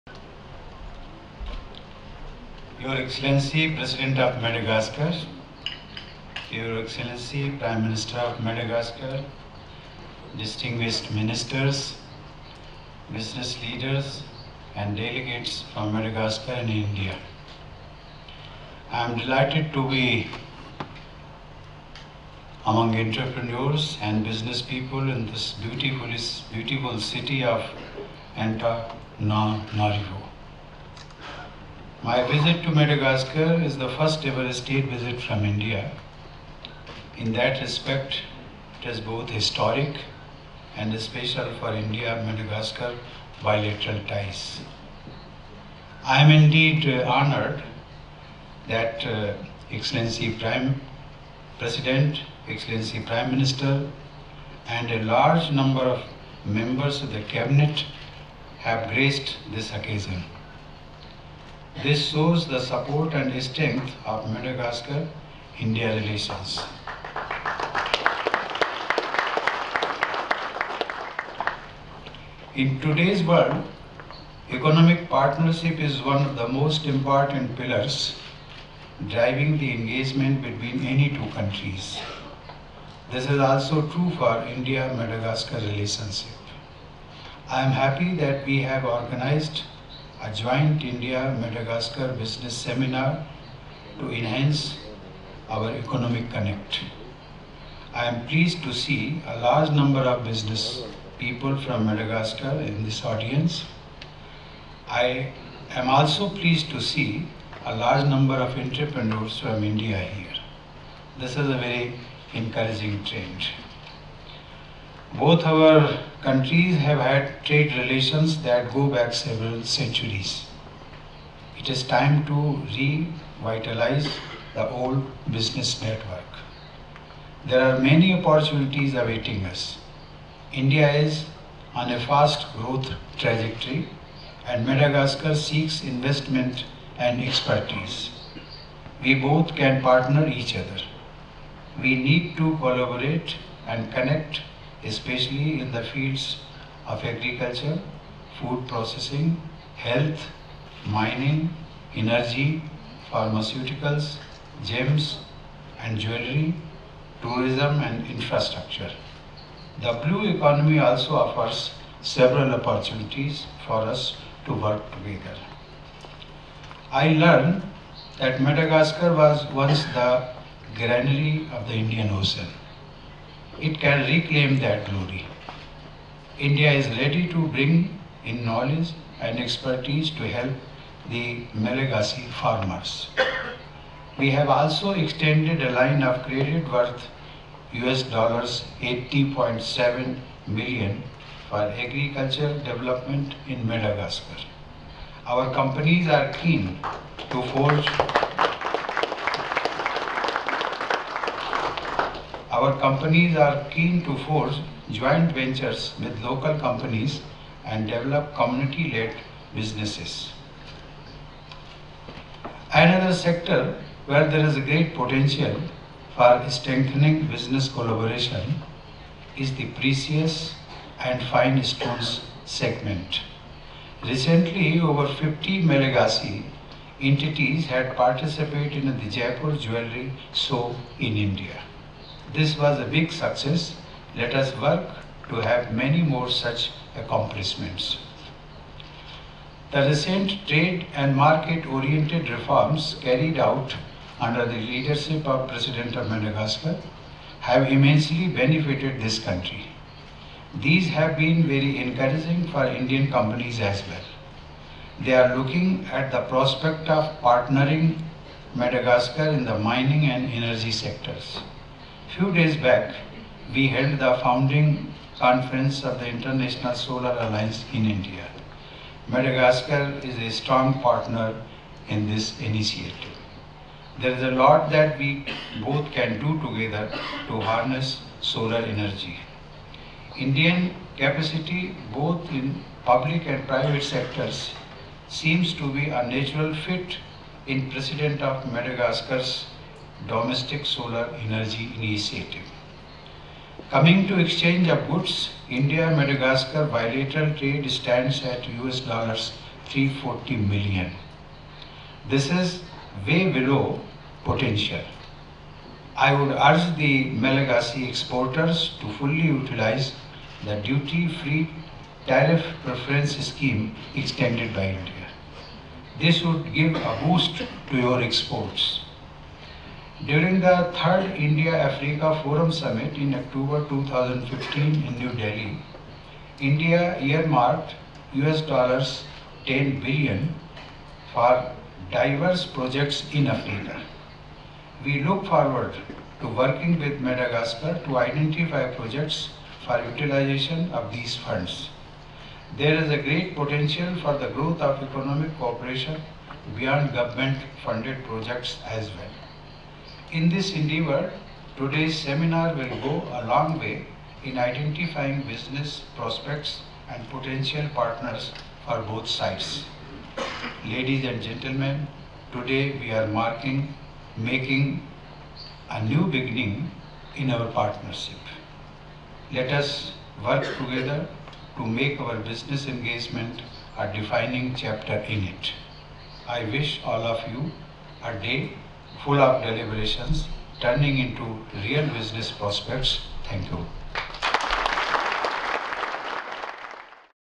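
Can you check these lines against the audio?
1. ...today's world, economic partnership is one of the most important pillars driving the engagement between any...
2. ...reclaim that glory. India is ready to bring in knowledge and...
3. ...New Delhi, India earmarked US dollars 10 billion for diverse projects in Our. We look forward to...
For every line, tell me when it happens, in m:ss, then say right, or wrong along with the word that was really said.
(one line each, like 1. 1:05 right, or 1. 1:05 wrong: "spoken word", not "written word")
1. 1:12 right
2. 2:54 right
3. 5:24 wrong: "Africa", not "Our".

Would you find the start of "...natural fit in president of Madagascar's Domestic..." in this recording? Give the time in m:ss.
4:46.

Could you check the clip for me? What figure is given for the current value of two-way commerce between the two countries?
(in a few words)
US$340 million.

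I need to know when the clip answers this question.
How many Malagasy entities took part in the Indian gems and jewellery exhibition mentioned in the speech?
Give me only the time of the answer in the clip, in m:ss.
3:44.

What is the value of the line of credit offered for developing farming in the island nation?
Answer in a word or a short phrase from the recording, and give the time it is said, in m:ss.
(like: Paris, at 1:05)
US$80.7 million, at 3:07.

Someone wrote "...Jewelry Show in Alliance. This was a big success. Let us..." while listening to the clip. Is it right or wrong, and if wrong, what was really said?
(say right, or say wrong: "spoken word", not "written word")
wrong: "India", not "Alliance".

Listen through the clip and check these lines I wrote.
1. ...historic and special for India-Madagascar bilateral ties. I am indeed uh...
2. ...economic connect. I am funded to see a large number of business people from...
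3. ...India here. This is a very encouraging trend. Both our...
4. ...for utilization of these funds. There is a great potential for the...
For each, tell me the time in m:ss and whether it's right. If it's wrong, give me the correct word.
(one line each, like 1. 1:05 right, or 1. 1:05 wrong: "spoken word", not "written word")
1. 0:39 right
2. 1:35 wrong: "pleased", not "funded"
3. 1:49 right
4. 5:39 right.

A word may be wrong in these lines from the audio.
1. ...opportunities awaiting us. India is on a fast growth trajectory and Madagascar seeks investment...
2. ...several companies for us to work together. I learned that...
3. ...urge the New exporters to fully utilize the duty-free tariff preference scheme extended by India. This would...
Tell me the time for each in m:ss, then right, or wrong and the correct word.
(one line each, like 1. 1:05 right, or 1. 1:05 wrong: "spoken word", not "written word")
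1. 2:08 right
2. 2:42 wrong: "opportunities", not "companies"
3. 5:06 wrong: "Malagasy", not "New".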